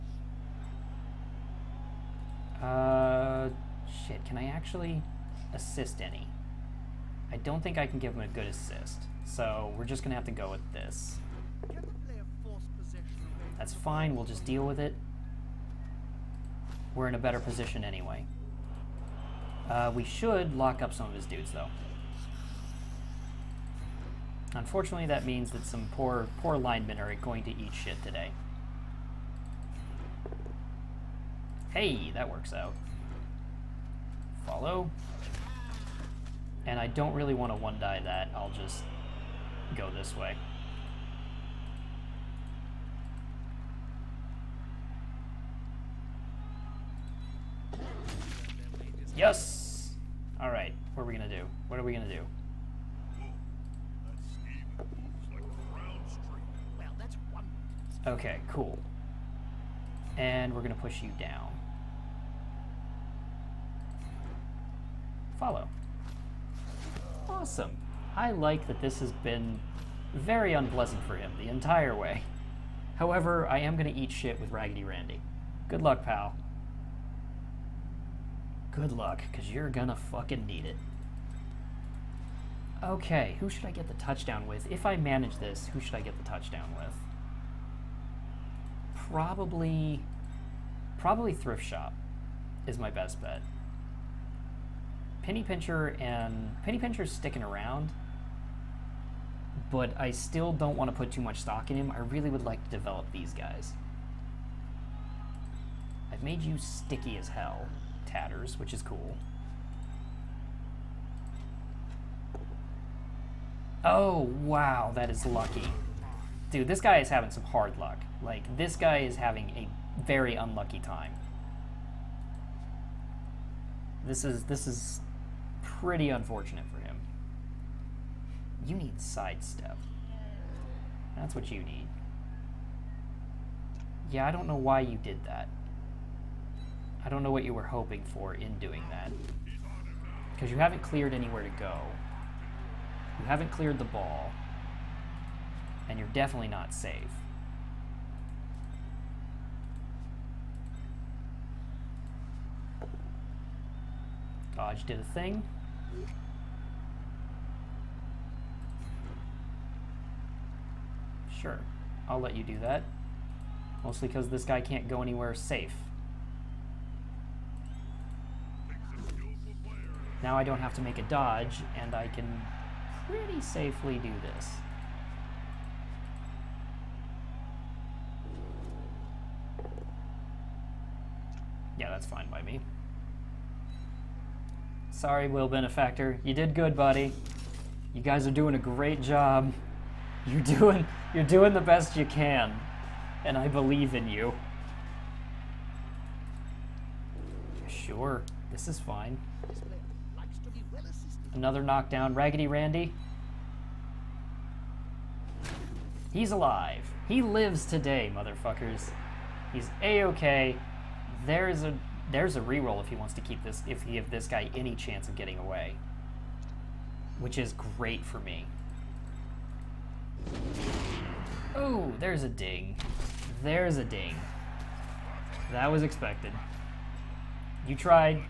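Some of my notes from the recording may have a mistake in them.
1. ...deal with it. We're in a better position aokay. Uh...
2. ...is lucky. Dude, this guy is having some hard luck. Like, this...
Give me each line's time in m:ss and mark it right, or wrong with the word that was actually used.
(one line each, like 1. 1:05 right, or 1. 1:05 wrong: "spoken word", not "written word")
1. 0:14 wrong: "anyway", not "aokay"
2. 1:55 right.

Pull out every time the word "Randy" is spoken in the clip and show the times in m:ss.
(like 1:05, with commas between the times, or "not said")
1:14, 3:22.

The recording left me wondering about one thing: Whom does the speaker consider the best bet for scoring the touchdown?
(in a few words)
Thrift Shop.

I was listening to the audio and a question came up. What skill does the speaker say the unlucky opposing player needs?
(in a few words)
Sidestep.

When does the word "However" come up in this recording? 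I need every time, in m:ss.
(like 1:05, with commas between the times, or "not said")
1:12.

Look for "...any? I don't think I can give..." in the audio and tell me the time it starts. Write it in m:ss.
0:06.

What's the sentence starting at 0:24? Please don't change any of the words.
Unfortunately, that means that some poor, poor linemen are going to eat shit today.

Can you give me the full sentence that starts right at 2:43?
Mostly because this guy can't go anywhere safe.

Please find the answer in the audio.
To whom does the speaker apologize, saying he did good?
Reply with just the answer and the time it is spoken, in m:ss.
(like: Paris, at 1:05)
Will Benefactor, at 3:05.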